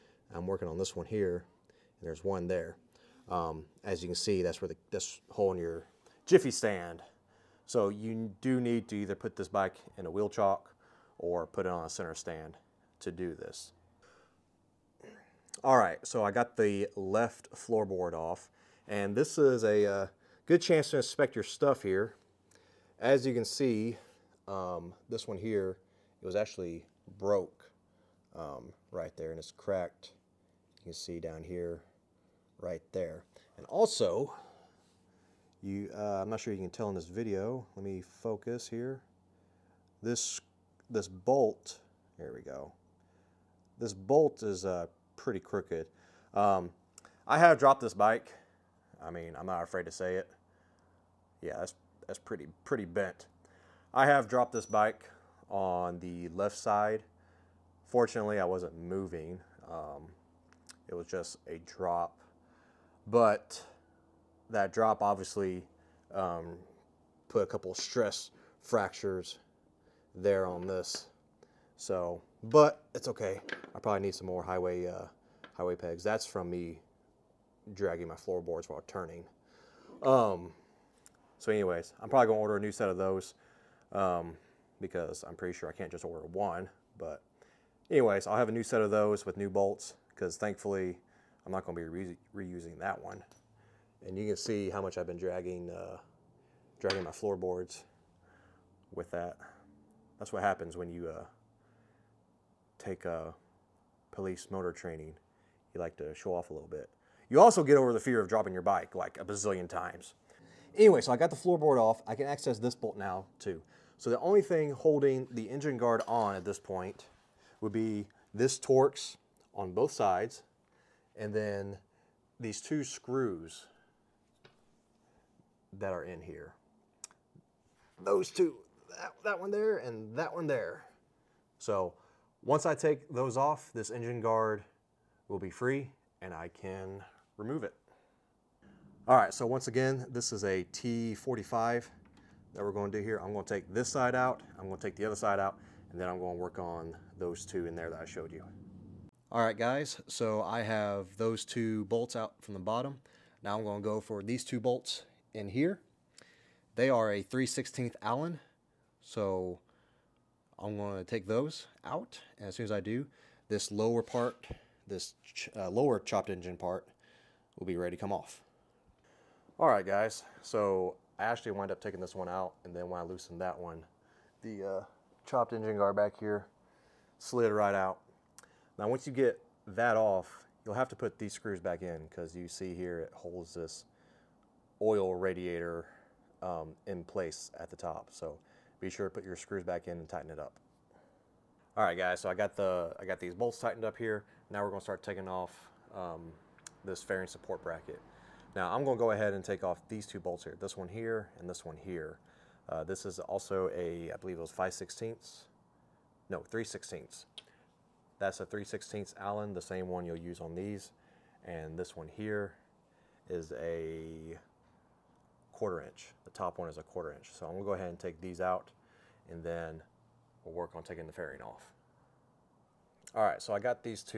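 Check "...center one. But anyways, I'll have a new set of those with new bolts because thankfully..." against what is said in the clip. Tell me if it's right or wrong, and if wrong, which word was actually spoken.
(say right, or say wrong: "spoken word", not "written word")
wrong: "order", not "center".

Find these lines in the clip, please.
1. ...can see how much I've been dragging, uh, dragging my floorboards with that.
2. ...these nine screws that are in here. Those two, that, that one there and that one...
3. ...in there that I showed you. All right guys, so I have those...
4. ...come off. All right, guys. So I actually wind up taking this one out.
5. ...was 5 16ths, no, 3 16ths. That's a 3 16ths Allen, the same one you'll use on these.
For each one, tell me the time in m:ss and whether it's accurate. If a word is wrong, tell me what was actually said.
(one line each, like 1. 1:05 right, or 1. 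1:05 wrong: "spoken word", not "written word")
1. 1:34 right
2. 2:02 wrong: "two", not "nine"
3. 2:27 right
4. 2:48 right
5. 3:24 right.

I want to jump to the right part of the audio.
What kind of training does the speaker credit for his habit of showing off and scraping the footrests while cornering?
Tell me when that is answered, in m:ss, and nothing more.
1:44.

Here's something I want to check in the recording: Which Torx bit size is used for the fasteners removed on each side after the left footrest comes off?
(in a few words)
T45.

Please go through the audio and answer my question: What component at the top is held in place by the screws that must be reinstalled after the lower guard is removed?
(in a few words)
oil radiator.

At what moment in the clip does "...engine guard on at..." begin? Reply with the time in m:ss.
1:55.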